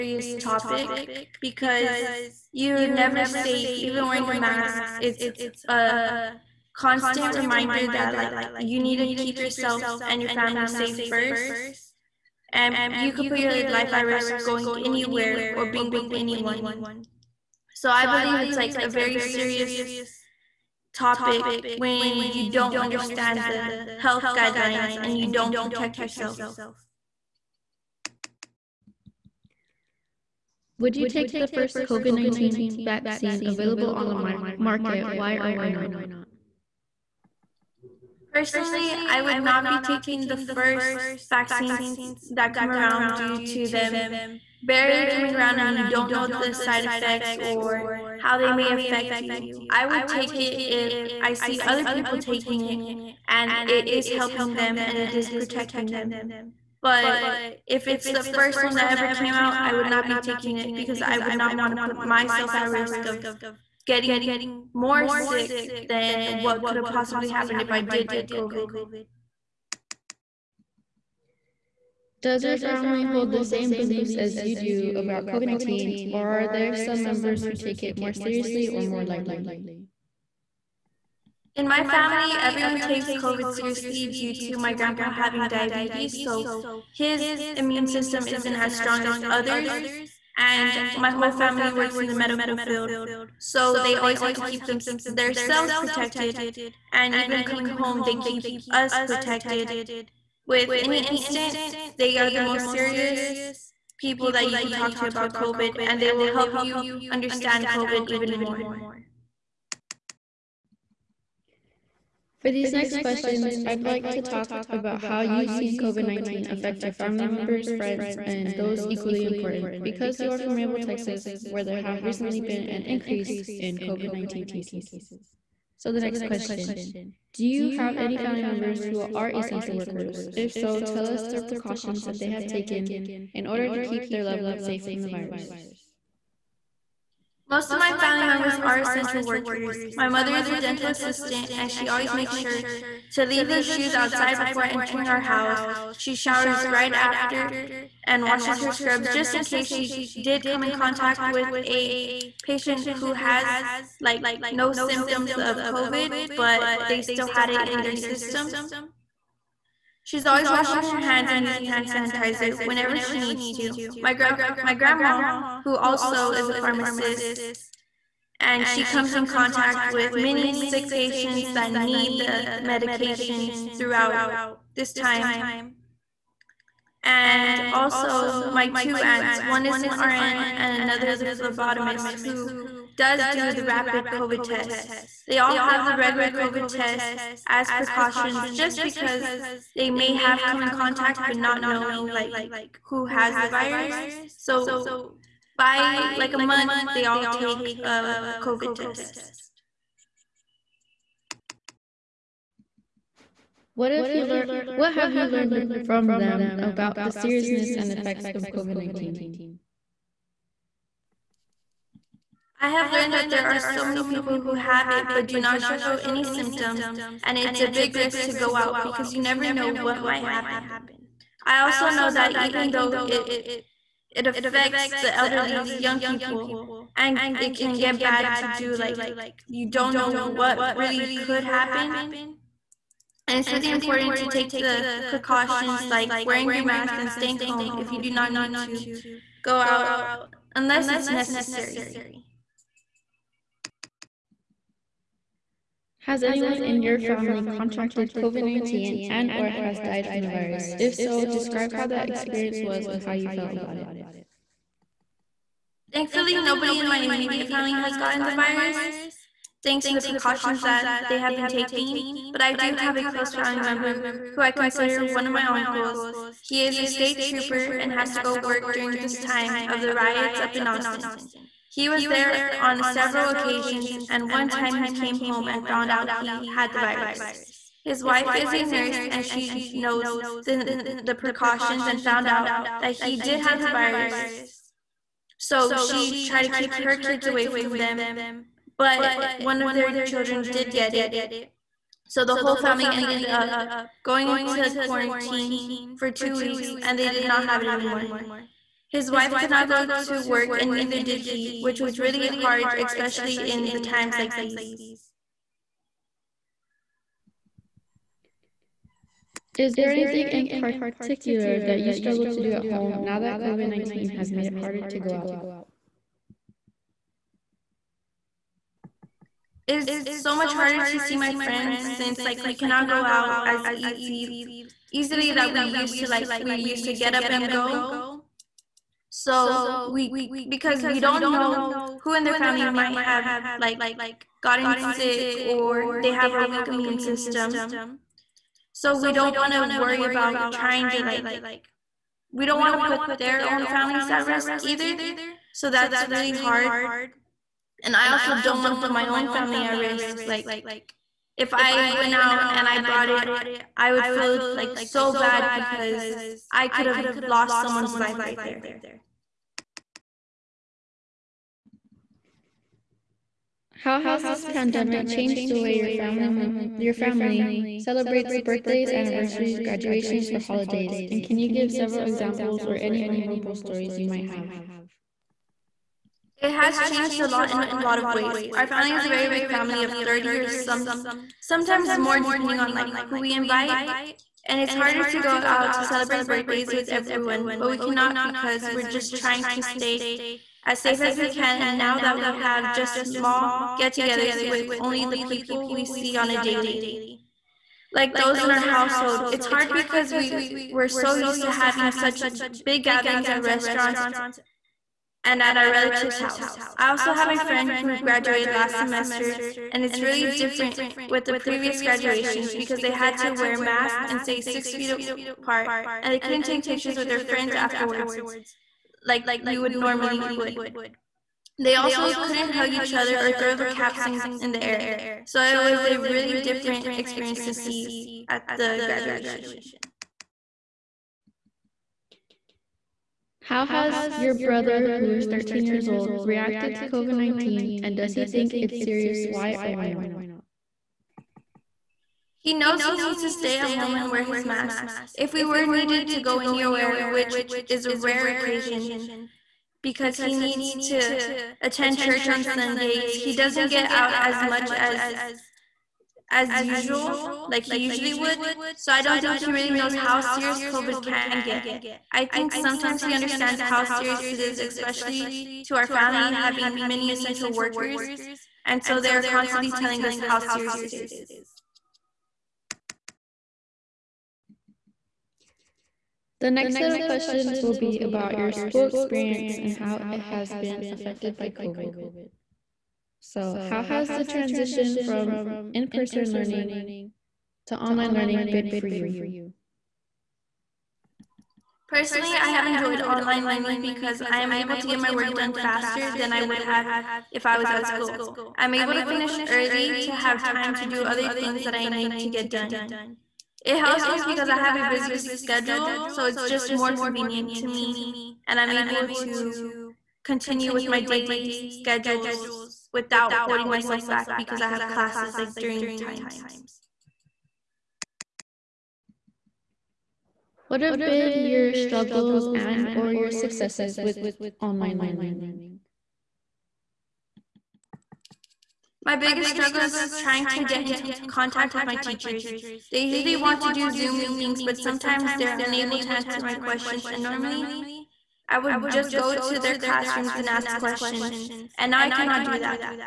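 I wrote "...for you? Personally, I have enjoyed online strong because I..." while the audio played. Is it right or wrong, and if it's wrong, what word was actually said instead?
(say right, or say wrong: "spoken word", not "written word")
wrong: "learning", not "strong".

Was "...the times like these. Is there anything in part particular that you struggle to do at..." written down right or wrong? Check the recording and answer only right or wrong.
right.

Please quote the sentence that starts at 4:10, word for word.
If so, describe how that experience was and how you felt about it.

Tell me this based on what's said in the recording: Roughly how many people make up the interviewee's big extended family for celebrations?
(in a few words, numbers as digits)
30.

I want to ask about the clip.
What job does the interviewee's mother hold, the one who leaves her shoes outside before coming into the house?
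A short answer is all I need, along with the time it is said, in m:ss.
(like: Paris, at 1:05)
Dental assistant, at 2:20.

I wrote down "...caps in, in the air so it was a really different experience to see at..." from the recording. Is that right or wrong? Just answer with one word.
right.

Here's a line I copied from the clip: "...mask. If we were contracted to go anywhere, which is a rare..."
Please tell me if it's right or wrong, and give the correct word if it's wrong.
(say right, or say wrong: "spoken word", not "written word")
wrong: "needed", not "contracted".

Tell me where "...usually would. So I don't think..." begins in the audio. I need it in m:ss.
7:37.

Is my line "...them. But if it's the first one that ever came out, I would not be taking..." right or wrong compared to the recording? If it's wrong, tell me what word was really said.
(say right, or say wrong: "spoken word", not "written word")
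right.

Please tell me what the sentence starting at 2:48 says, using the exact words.
And she comes in contact with many sick patients that need the medications throughout this time.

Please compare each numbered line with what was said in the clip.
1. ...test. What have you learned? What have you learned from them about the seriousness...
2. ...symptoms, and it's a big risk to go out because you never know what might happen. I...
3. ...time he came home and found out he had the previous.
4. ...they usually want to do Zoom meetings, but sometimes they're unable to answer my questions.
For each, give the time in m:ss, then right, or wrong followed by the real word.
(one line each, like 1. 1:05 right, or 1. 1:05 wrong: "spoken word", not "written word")
1. 3:18 right
2. 3:36 right
3. 4:34 wrong: "virus", not "previous"
4. 8:52 right.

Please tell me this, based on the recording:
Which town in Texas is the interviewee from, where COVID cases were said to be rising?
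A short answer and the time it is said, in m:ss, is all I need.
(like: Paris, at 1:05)
Raymondville, at 2:00.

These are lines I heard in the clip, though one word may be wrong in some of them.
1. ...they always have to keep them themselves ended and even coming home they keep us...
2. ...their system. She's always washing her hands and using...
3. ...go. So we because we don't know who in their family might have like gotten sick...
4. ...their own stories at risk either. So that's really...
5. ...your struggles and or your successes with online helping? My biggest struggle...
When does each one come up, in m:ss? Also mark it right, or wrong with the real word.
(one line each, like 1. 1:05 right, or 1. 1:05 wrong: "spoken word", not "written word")
1. 1:33 wrong: "protected", not "ended"
2. 2:37 right
3. 5:27 right
4. 5:43 wrong: "families", not "stories"
5. 8:41 wrong: "learning", not "helping".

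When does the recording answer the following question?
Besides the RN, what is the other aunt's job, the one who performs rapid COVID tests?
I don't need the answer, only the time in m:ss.
3:01.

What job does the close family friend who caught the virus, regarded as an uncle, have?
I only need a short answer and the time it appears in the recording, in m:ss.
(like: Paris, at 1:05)
State trooper, at 4:26.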